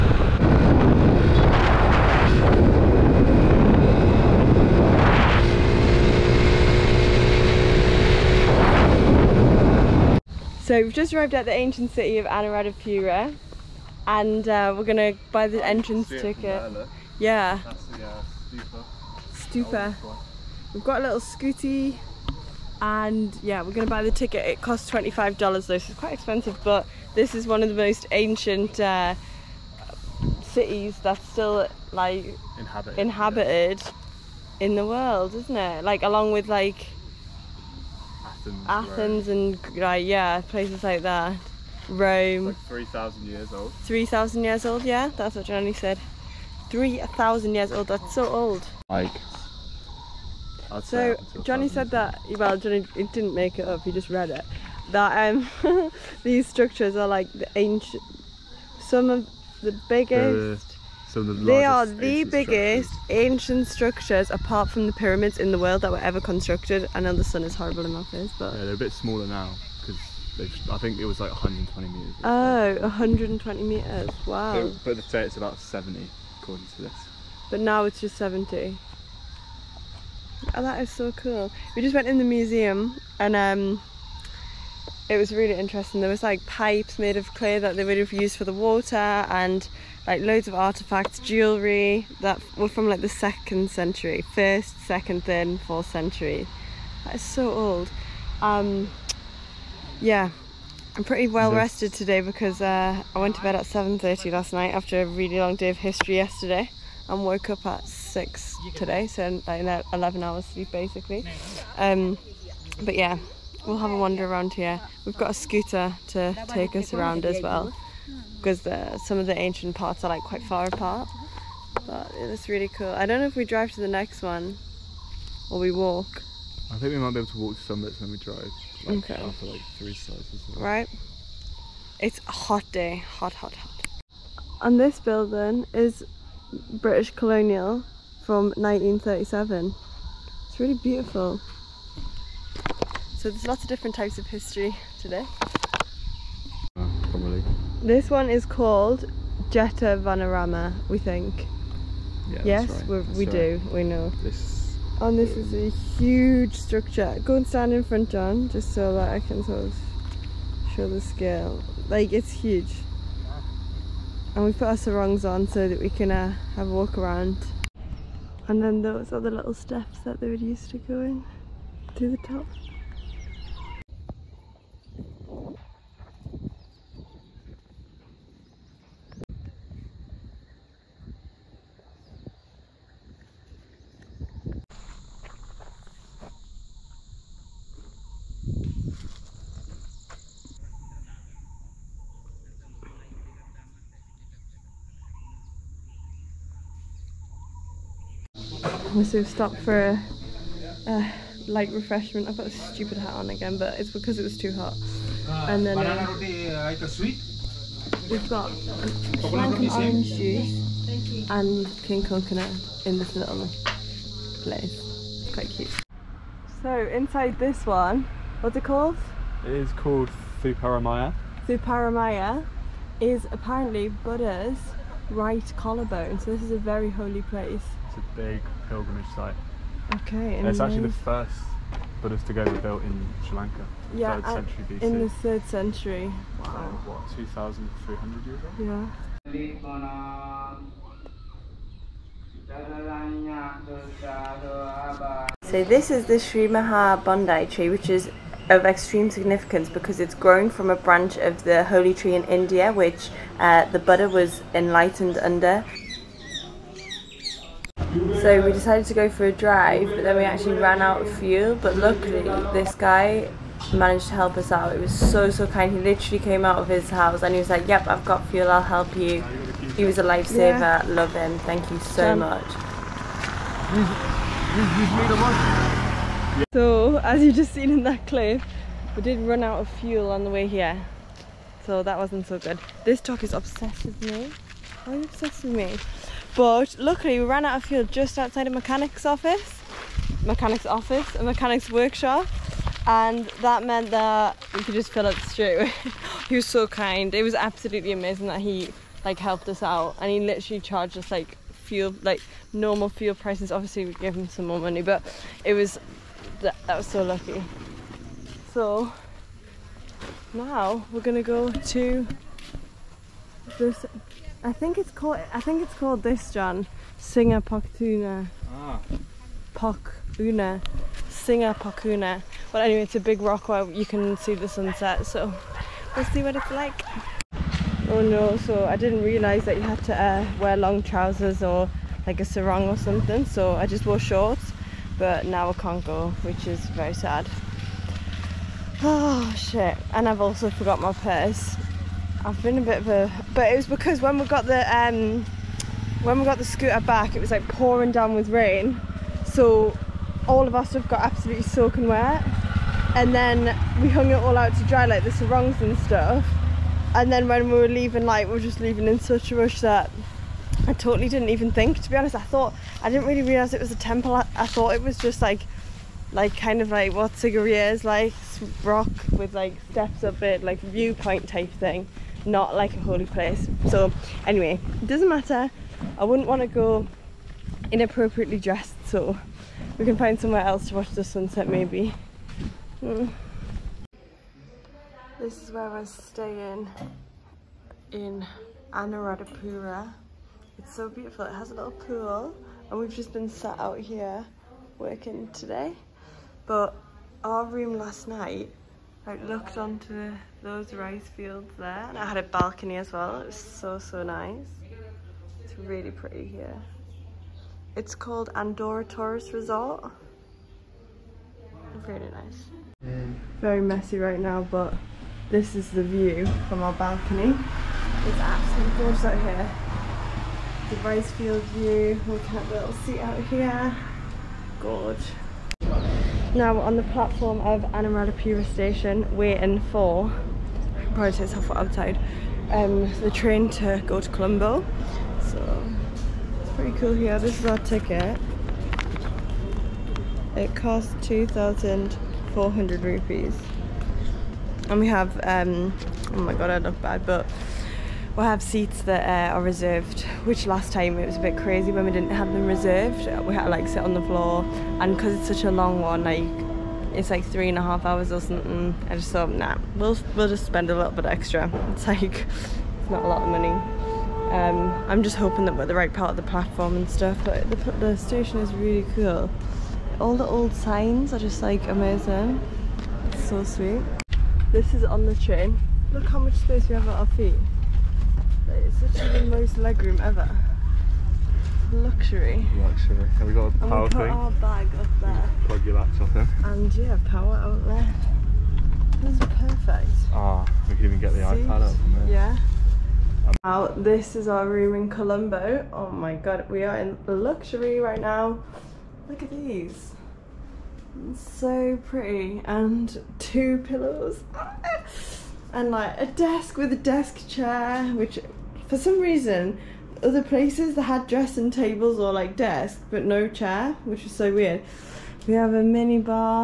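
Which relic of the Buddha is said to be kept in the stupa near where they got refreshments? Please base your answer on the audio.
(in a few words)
Right collarbone.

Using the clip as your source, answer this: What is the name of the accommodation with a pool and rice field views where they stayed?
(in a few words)
Andorra Tourist Resort.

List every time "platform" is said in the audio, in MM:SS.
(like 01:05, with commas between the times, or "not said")
07:06, 07:46.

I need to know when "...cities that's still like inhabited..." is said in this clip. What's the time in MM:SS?
00:30.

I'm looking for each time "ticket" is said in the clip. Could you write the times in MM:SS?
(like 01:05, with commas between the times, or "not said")
00:16, 00:24, 07:17.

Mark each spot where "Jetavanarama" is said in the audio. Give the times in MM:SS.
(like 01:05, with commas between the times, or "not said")
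02:29.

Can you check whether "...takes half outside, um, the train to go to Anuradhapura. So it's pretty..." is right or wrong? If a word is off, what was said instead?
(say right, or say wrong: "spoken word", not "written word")
wrong: "Colombo", not "Anuradhapura".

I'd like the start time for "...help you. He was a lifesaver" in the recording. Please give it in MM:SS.
04:28.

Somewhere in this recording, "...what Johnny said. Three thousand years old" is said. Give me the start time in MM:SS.
00:45.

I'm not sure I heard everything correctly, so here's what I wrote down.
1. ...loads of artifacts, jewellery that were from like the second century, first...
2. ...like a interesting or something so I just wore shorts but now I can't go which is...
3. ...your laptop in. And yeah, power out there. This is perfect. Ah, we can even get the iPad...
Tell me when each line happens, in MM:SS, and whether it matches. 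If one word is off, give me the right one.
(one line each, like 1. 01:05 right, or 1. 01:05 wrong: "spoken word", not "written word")
1. 01:30 right
2. 05:32 wrong: "sarong", not "interesting"
3. 08:05 right.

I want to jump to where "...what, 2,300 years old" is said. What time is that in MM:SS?
03:56.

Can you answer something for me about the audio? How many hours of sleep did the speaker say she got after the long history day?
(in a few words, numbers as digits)
11.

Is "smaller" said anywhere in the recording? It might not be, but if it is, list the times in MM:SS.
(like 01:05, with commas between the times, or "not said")
01:08.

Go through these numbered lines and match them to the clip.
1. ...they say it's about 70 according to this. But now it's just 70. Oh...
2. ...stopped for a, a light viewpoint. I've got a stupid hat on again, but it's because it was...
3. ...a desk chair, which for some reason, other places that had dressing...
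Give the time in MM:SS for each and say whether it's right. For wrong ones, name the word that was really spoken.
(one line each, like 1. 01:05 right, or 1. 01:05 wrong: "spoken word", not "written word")
1. 01:14 right
2. 03:19 wrong: "refreshment", not "viewpoint"
3. 08:26 right.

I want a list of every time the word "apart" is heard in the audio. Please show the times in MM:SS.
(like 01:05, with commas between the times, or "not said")
01:04, 02:00.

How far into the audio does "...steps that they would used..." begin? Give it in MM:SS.
02:49.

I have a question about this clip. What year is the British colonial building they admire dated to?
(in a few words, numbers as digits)
1937.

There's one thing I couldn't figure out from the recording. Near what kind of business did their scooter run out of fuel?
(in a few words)
Mechanic's workshop.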